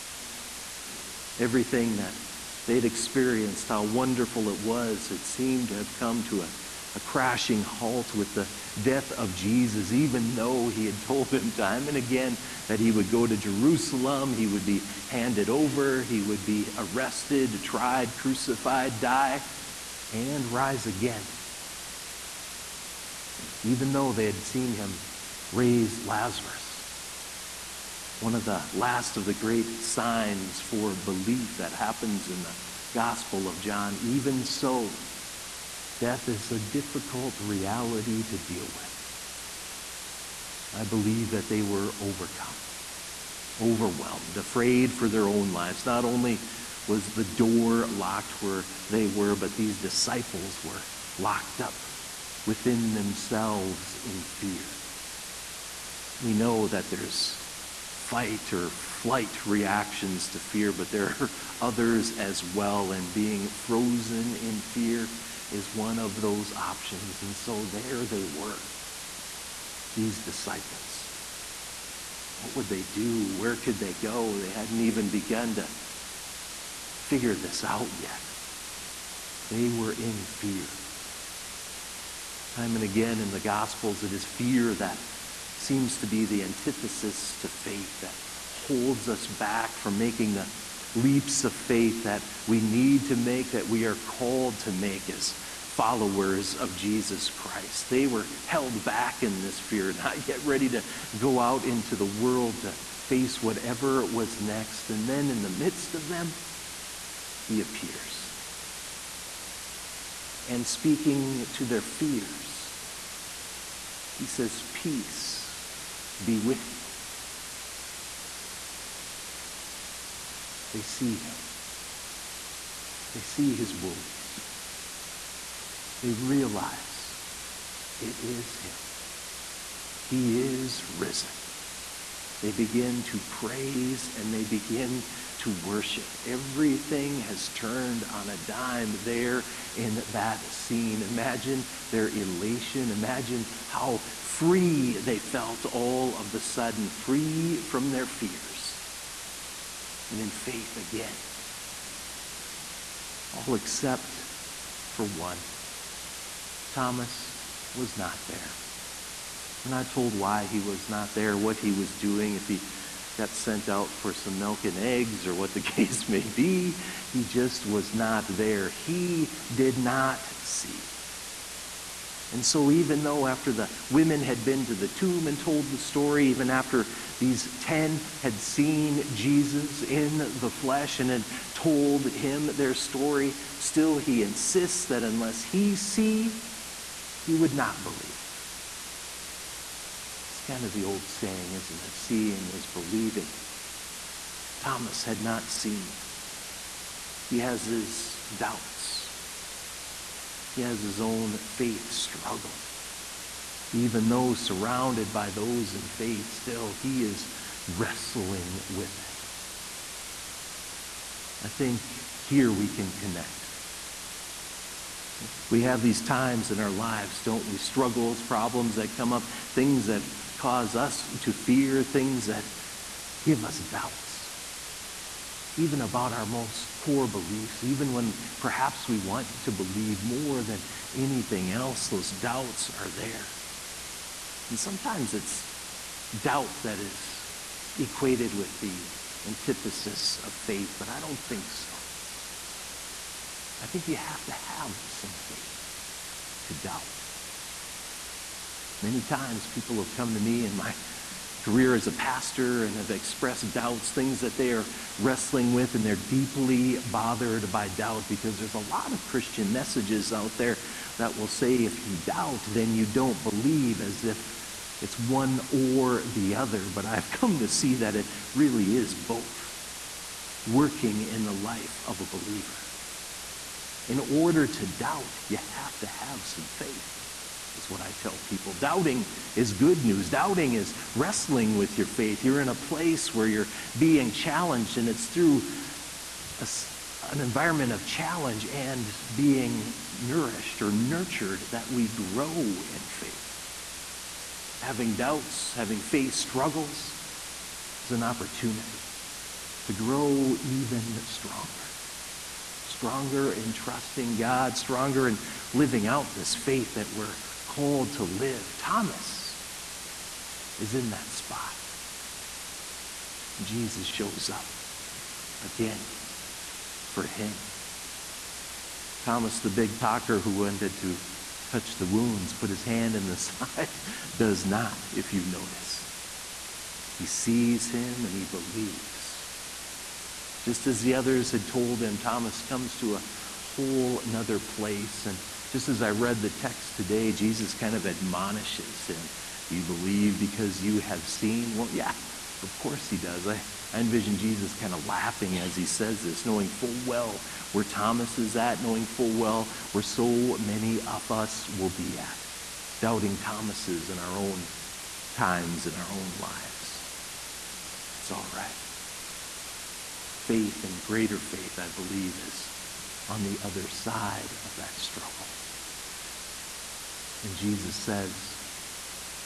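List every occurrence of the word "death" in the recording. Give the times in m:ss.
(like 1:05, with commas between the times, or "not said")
0:08, 0:35.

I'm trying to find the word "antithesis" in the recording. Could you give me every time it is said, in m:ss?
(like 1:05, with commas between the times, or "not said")
1:26, 3:59.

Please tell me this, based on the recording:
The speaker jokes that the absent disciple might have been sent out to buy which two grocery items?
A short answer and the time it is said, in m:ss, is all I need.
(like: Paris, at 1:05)
Milk and eggs, at 2:44.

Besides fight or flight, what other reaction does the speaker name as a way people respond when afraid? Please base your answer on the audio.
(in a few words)
Being frozen.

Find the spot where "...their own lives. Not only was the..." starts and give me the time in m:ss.
0:45.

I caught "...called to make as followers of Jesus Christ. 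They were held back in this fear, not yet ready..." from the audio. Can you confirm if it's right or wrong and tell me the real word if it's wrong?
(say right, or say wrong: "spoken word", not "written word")
right.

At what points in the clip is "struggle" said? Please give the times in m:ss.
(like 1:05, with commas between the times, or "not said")
3:21, 3:37, 4:56, 6:04.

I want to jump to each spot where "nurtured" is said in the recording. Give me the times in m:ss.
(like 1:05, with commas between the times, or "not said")
4:50.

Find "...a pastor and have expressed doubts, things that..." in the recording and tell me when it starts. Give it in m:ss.
4:11.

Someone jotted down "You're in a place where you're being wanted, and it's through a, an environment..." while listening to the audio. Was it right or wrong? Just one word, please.
wrong.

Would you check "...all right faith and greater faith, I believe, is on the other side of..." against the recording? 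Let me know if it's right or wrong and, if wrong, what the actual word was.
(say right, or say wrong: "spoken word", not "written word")
right.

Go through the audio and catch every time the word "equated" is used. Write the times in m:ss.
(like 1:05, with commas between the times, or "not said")
3:57.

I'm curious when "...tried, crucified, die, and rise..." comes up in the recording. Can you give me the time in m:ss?
0:17.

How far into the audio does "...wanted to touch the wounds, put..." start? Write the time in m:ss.
5:20.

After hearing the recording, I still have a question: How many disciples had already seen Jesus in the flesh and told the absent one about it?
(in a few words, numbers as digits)
10.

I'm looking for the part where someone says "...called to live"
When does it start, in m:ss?
5:07.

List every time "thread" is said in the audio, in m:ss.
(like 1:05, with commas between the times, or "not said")
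not said.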